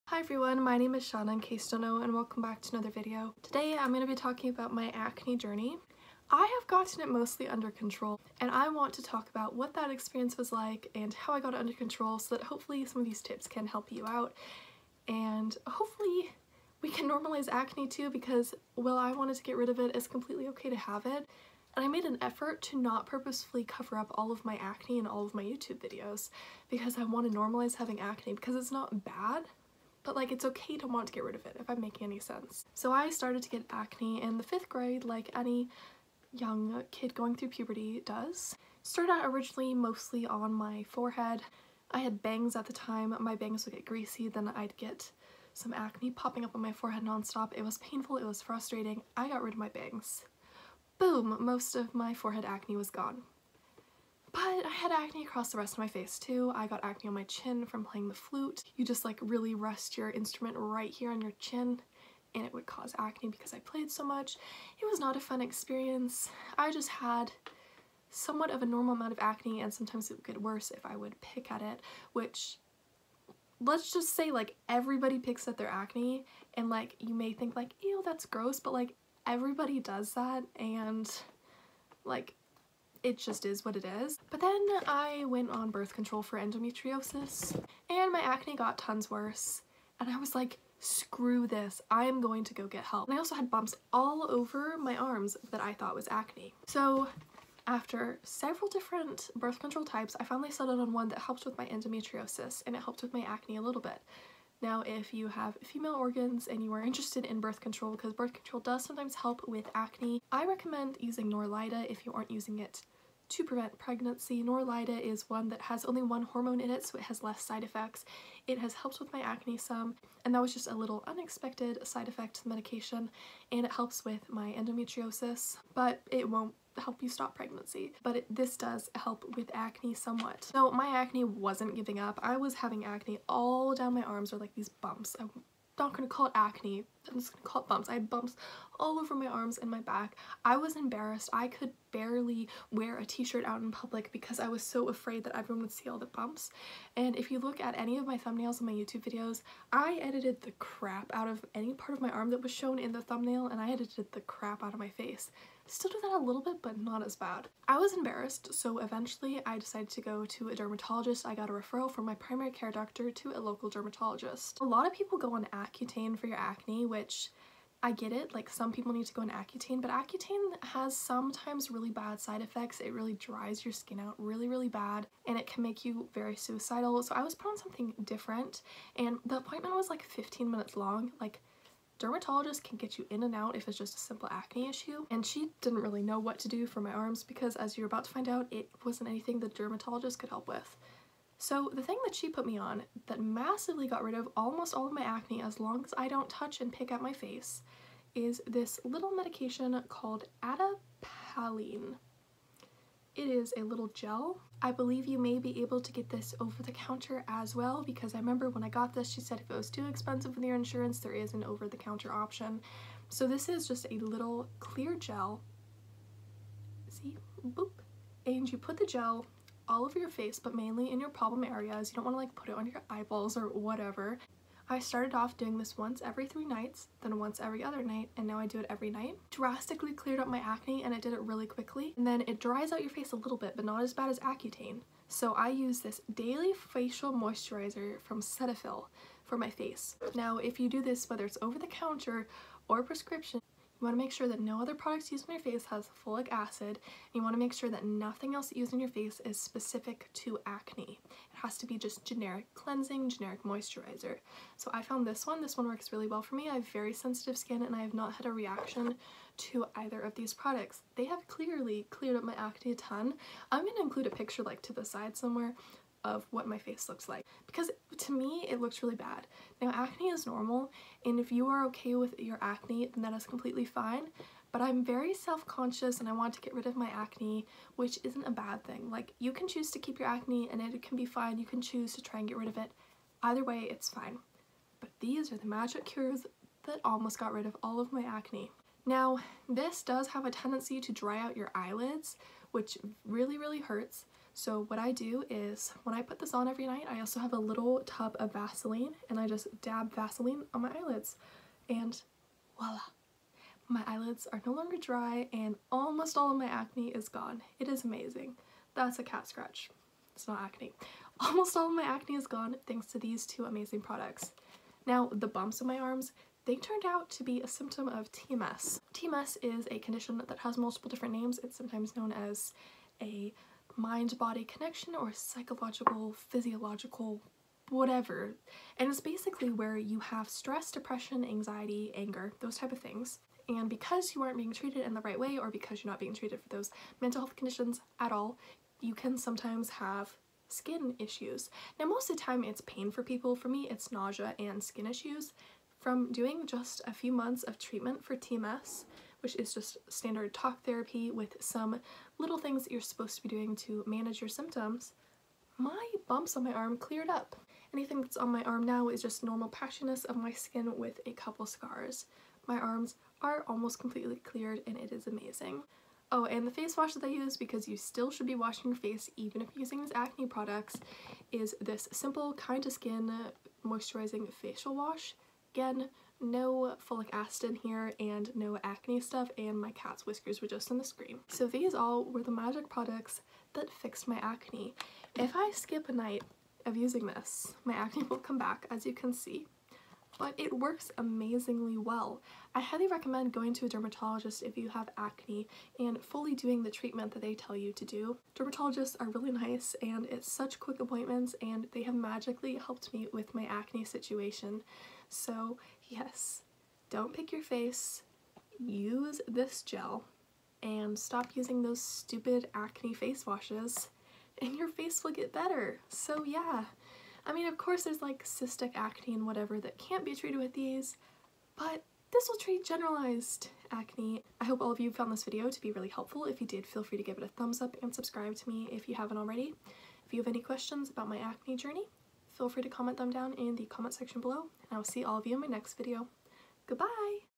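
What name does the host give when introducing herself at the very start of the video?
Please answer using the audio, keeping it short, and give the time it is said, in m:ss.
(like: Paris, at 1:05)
Shawna, at 0:01.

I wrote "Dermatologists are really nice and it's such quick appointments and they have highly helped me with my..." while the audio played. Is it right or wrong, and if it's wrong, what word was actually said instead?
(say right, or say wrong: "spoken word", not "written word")
wrong: "magically", not "highly".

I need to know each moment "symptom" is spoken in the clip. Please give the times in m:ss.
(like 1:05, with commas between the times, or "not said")
5:17, 5:54.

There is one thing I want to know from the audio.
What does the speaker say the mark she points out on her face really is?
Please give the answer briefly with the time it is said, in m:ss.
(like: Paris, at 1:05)
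a cat scratch, at 5:09.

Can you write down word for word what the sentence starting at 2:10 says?
So my acne wasn't giving up.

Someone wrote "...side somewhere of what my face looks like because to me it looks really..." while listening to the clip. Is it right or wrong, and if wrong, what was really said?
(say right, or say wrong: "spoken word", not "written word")
right.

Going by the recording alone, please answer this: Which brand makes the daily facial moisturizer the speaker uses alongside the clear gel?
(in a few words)
Cetaphil.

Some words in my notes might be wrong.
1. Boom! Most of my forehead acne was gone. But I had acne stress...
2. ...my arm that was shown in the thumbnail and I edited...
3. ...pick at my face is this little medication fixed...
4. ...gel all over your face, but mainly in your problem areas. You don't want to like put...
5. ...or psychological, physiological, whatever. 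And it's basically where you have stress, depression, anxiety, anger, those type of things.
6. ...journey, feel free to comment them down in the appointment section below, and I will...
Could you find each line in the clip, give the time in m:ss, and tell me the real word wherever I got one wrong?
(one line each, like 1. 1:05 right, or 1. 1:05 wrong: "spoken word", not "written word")
1. 0:50 wrong: "across", not "stress"
2. 2:32 right
3. 3:16 wrong: "called", not "fixed"
4. 3:38 right
5. 5:24 right
6. 7:11 wrong: "comment", not "appointment".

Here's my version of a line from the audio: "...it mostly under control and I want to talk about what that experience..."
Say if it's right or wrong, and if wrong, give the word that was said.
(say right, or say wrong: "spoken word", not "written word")
right.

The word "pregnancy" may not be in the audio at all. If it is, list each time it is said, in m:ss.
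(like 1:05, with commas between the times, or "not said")
1:53, 2:07.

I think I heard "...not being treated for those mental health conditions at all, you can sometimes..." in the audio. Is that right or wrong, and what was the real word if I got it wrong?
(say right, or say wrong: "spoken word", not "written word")
right.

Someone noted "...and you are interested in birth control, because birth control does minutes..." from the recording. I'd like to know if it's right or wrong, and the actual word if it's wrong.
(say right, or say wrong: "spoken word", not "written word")
wrong: "sometimes", not "minutes".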